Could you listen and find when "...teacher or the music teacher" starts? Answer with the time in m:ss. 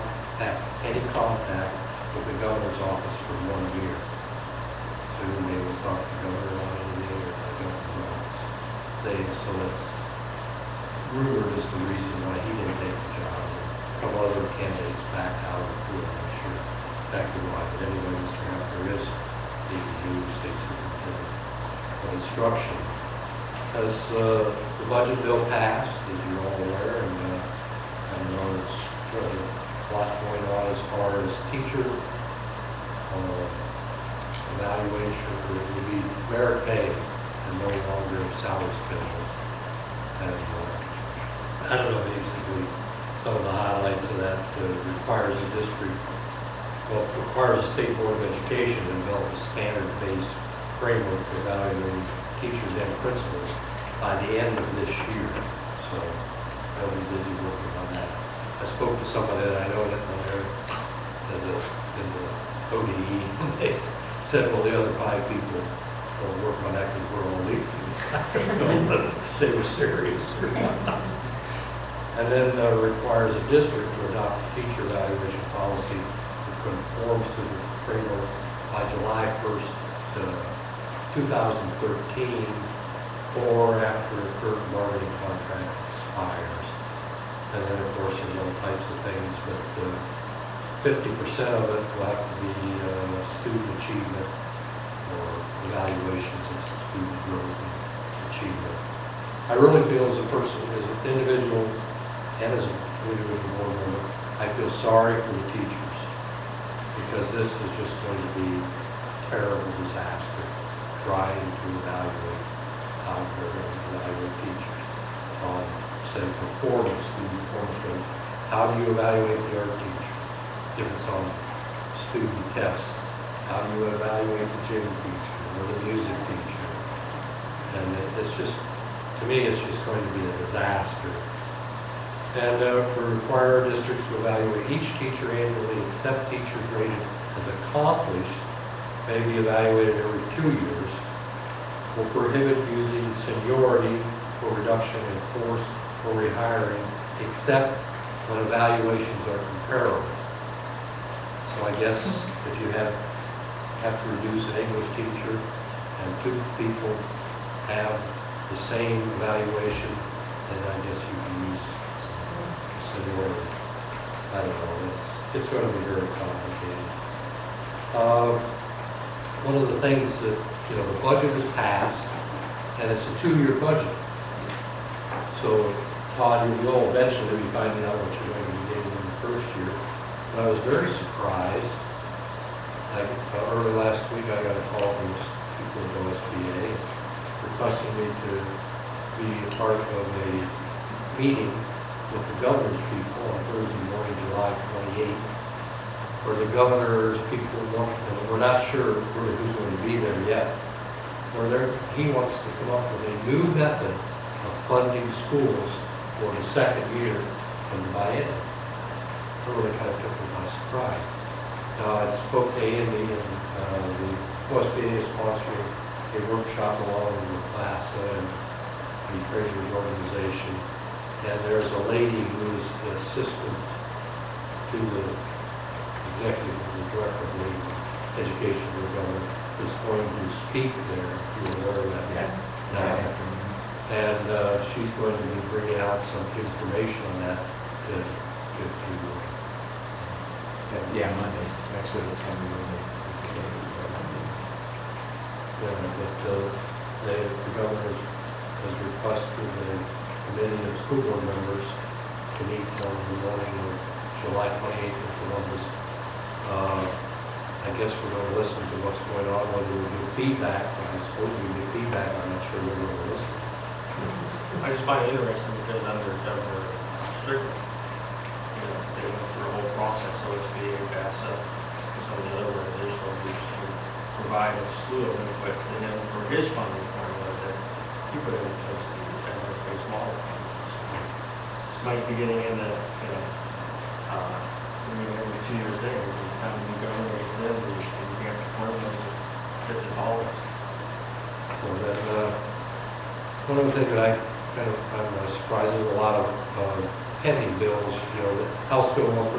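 2:04.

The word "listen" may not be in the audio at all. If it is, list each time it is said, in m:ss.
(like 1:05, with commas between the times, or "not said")
4:18, 4:23.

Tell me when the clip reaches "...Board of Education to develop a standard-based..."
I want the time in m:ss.
0:47.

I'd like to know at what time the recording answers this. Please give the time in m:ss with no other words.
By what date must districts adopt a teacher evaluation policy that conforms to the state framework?
1:18.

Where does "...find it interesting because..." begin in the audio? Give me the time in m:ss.
4:24.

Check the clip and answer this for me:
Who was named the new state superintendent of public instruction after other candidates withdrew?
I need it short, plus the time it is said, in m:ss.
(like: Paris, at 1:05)
Mr. Heffner, at 0:18.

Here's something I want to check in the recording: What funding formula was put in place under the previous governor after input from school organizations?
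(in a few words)
evidence-based model.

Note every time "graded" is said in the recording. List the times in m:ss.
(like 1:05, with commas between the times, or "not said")
2:16.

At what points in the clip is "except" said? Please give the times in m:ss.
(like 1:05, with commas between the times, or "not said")
2:15, 2:27.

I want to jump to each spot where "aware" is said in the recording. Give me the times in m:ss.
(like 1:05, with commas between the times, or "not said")
0:26, 3:51.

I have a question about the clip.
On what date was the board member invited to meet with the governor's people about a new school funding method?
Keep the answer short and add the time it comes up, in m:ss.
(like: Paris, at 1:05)
July 28th, at 3:13.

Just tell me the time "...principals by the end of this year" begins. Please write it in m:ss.
0:53.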